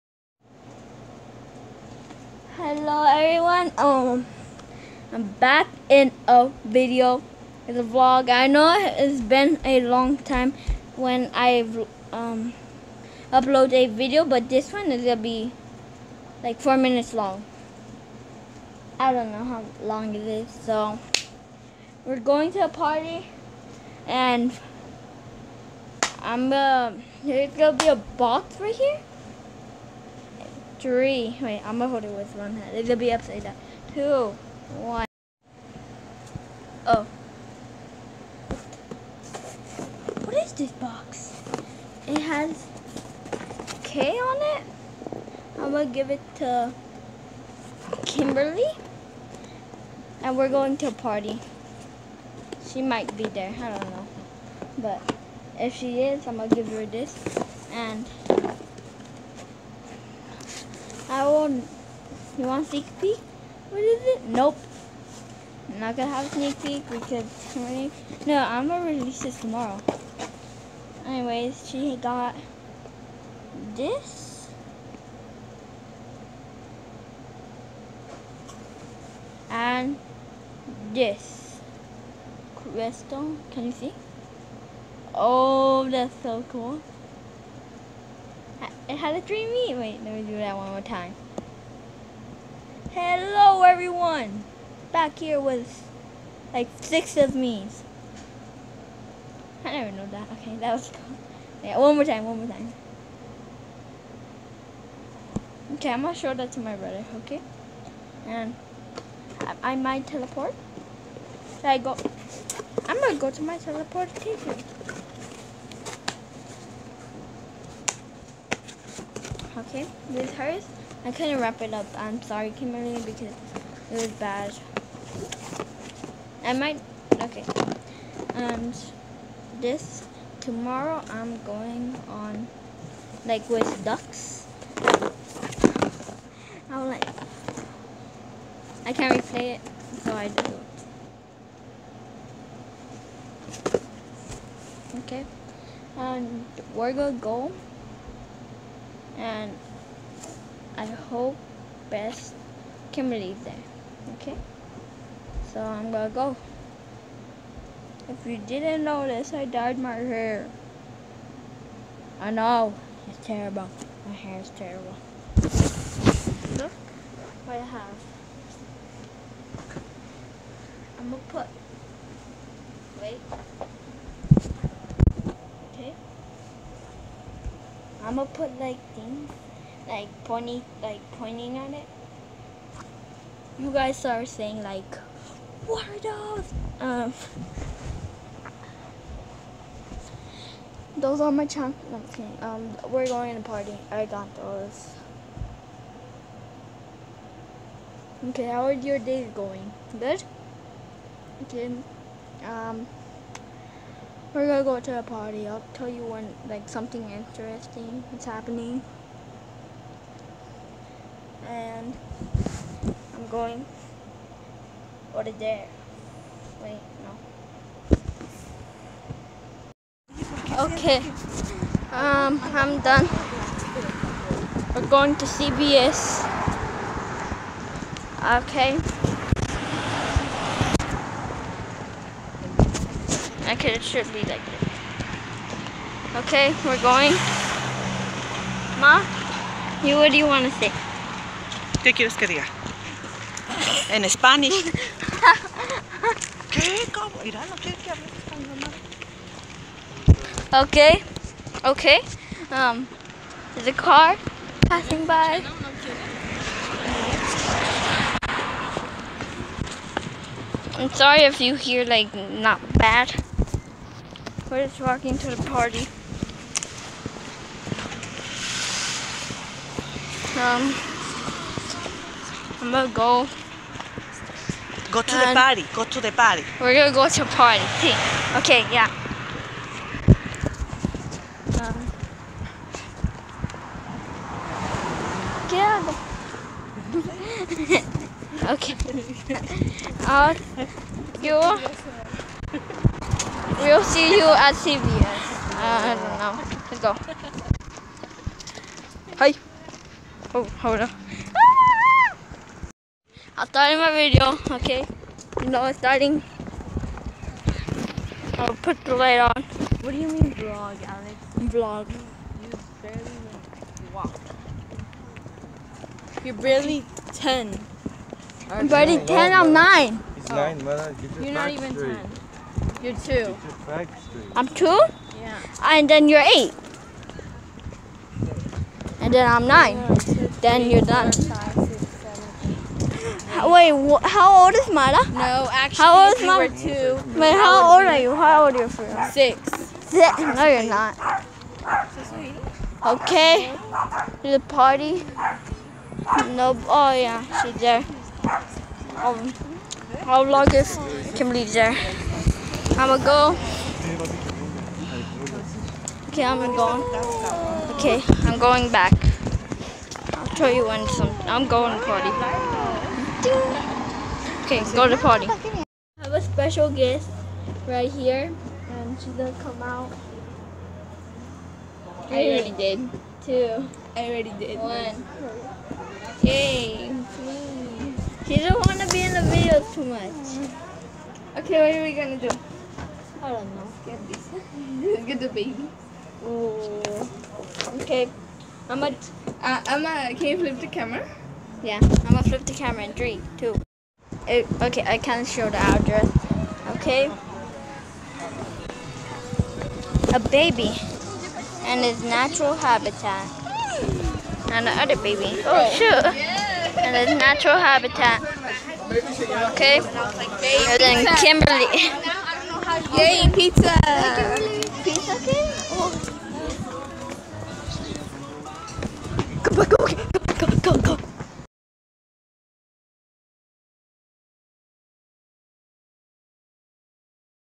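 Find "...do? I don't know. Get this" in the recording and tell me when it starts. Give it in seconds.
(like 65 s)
382 s.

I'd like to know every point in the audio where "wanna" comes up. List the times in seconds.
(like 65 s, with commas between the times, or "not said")
378 s.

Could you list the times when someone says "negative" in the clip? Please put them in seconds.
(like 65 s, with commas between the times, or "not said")
not said.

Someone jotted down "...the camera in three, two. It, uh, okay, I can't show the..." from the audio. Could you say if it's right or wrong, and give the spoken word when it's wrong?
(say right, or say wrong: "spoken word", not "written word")
right.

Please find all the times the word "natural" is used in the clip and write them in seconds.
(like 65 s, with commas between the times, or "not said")
402 s, 407 s.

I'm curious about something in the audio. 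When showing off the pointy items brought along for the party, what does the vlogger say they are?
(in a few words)
chocolates.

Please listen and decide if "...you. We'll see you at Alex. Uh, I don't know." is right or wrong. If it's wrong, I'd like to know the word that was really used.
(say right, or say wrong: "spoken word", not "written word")
wrong: "CVS", not "Alex".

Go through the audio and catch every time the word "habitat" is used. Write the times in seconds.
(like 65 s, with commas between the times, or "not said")
402 s, 407 s.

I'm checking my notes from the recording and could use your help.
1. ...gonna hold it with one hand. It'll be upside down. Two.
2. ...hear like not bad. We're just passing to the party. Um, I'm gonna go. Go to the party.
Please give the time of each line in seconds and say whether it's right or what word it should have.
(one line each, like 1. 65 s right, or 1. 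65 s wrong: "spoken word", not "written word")
1. 31 s right
2. 261 s wrong: "walking", not "passing".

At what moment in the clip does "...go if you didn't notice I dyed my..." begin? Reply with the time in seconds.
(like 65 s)
156 s.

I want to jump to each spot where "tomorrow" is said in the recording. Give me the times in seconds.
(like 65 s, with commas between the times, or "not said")
69 s, 130 s.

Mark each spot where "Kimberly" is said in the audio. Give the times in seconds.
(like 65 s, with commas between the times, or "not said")
48 s, 122 s, 351 s, 411 s.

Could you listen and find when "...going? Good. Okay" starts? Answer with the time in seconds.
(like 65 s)
199 s.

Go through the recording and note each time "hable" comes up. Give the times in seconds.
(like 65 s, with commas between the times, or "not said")
247 s.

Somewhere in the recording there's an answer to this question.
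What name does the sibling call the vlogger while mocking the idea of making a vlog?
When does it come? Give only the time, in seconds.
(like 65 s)
309 s.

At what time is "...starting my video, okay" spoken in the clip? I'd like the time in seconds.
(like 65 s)
303 s.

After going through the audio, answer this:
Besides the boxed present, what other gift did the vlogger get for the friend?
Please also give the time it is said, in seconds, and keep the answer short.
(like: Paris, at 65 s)
crystal, at 80 s.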